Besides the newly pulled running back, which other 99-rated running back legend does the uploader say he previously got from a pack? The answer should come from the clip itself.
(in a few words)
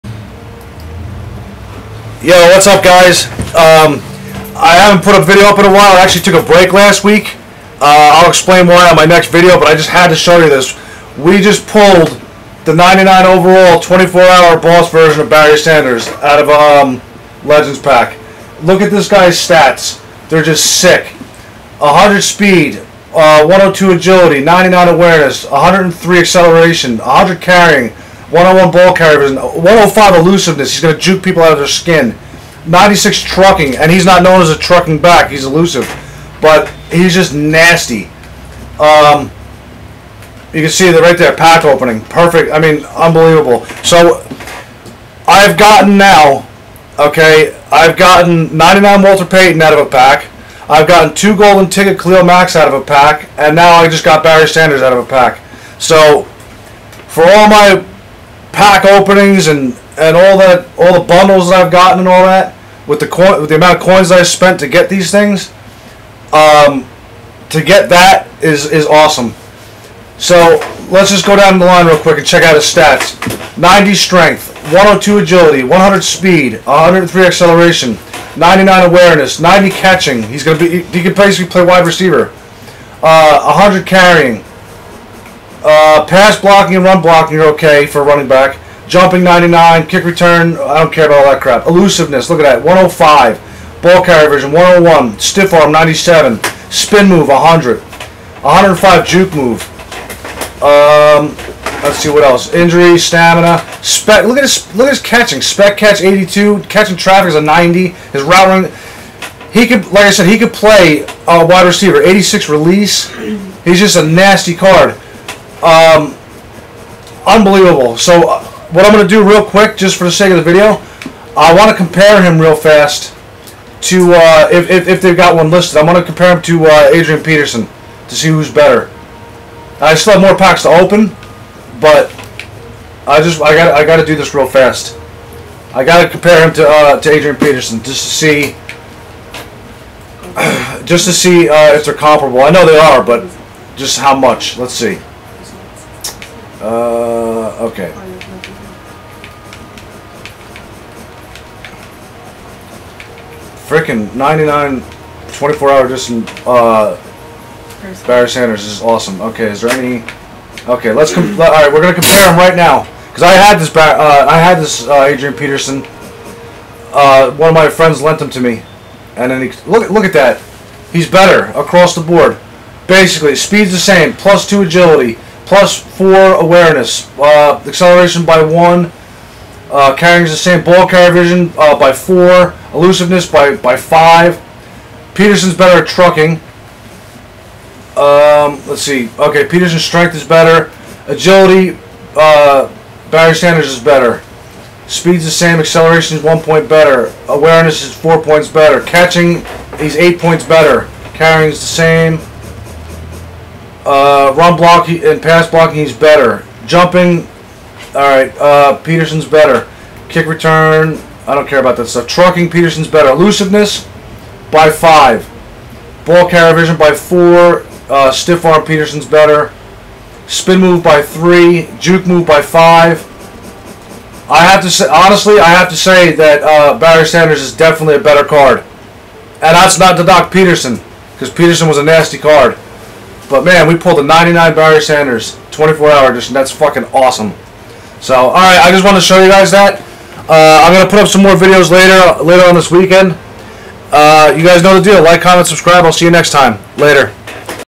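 Walter Payton.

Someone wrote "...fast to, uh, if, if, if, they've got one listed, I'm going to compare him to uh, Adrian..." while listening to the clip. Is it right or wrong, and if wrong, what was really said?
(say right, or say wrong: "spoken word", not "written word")
right.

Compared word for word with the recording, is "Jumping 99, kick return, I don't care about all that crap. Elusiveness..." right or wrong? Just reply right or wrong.
right.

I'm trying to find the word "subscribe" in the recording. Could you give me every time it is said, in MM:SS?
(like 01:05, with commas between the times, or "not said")
04:05.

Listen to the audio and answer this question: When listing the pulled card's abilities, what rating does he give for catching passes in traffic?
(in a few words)
90.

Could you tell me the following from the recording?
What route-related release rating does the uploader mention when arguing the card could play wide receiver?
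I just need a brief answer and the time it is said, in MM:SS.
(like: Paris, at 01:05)
86, at 01:52.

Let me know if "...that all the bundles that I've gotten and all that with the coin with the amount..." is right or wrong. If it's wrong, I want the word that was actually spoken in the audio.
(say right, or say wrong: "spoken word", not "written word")
right.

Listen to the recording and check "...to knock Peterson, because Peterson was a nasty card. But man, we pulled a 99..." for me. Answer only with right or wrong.
right.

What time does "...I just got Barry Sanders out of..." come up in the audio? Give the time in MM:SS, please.
00:53.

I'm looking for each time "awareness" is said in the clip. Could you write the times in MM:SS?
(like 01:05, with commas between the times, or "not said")
00:24, 01:18, 02:56, 03:17.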